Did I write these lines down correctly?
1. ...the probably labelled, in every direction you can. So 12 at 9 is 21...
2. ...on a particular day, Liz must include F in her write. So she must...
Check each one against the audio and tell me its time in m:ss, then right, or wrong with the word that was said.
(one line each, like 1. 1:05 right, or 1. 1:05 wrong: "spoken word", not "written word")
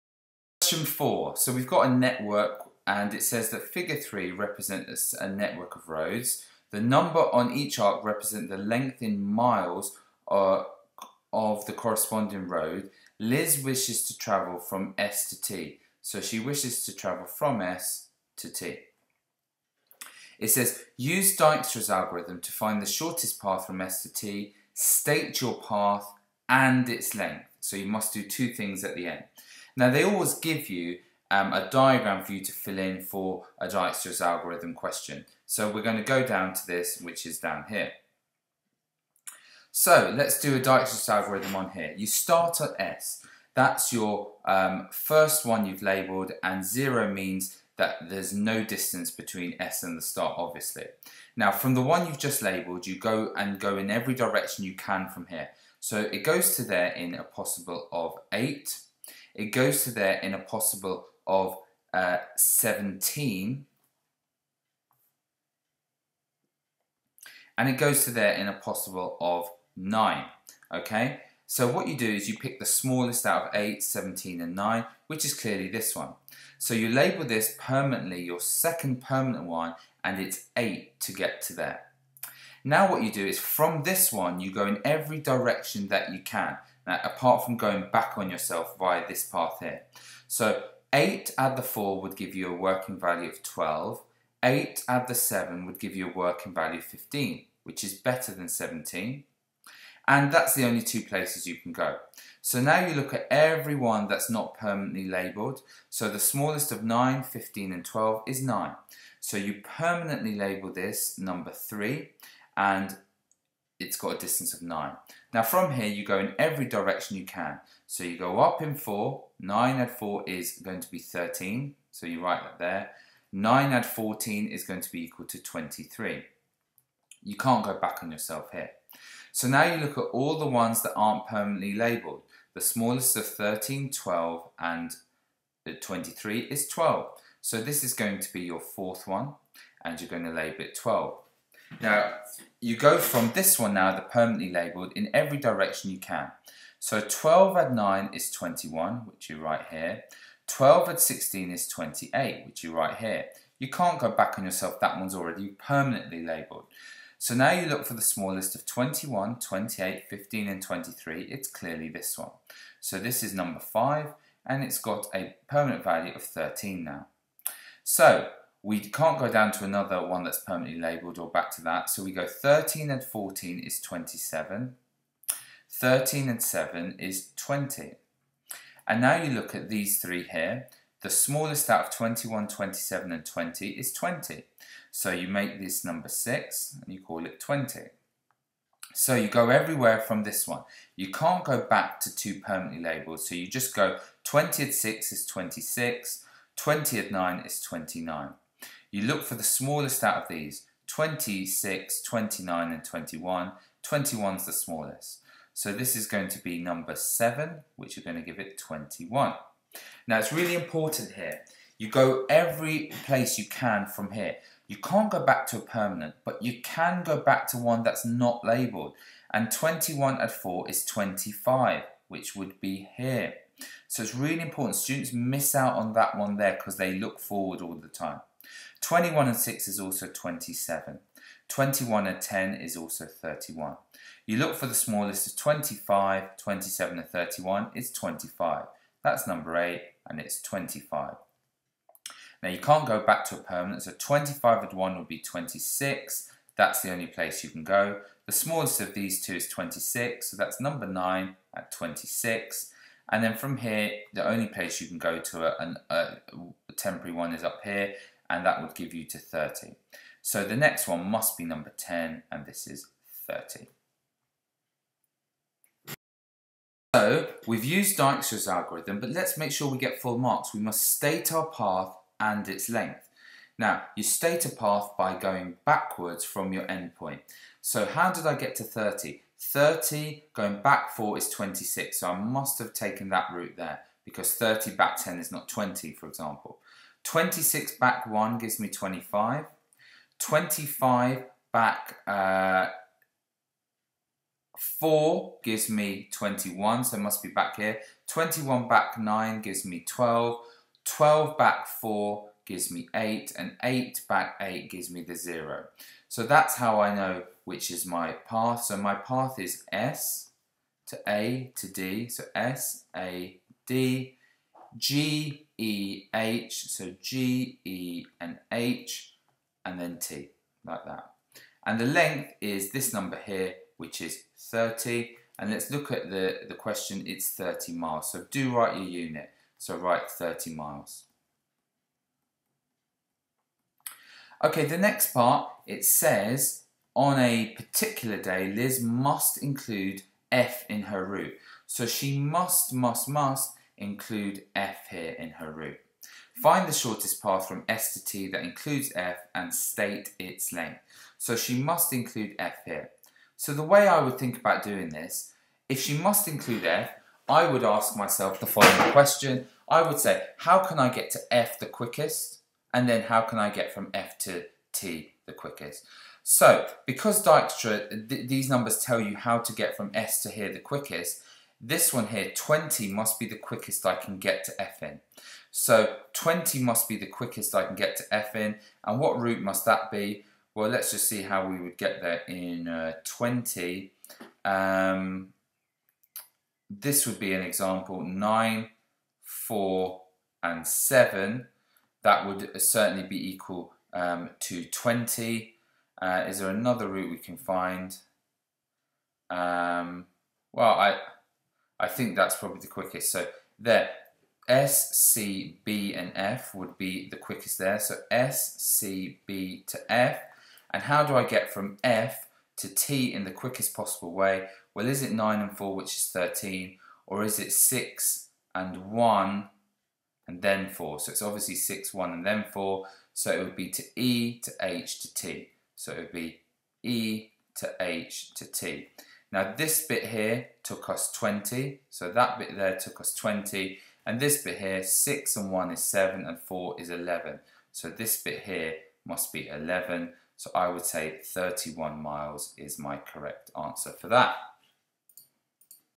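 1. 2:23 wrong: "permanently", not "probably"
2. 5:36 wrong: "route", not "write".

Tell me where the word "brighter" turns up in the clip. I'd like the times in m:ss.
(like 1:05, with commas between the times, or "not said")
not said.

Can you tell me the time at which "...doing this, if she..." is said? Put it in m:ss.
5:54.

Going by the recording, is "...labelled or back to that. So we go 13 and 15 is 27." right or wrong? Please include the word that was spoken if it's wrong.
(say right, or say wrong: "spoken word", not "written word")
wrong: "14", not "15".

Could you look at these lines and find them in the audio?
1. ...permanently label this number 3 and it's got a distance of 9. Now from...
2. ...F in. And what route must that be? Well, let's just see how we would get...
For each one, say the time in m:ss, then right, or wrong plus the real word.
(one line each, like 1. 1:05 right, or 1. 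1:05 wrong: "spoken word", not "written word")
1. 1:49 right
2. 6:18 right.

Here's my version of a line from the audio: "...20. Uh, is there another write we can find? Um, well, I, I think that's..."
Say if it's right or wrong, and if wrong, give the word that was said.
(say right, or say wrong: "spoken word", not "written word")
wrong: "route", not "write".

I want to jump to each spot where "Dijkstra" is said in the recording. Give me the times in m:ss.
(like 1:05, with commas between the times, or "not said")
0:21, 0:33, 0:40, 4:27, 6:07.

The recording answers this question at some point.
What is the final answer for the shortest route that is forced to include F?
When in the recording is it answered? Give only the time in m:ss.
7:21.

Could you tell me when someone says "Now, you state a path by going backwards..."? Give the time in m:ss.
4:33.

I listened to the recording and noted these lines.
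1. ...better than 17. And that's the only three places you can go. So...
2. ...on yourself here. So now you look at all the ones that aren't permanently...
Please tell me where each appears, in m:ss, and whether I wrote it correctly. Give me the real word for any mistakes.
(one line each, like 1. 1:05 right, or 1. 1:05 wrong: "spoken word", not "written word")
1. 1:37 wrong: "two", not "three"
2. 2:08 right.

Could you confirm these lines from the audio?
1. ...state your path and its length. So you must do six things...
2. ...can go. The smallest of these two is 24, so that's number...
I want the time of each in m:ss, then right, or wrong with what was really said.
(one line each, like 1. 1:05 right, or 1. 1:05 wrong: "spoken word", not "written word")
1. 0:24 wrong: "two", not "six"
2. 4:07 wrong: "26", not "24".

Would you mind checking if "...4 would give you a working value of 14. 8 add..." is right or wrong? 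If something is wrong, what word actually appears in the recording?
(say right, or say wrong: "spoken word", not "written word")
wrong: "12", not "14".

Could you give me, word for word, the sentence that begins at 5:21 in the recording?
And the length is this number here, which is 30.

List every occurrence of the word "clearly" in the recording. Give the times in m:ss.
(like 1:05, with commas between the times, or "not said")
1:15, 2:41.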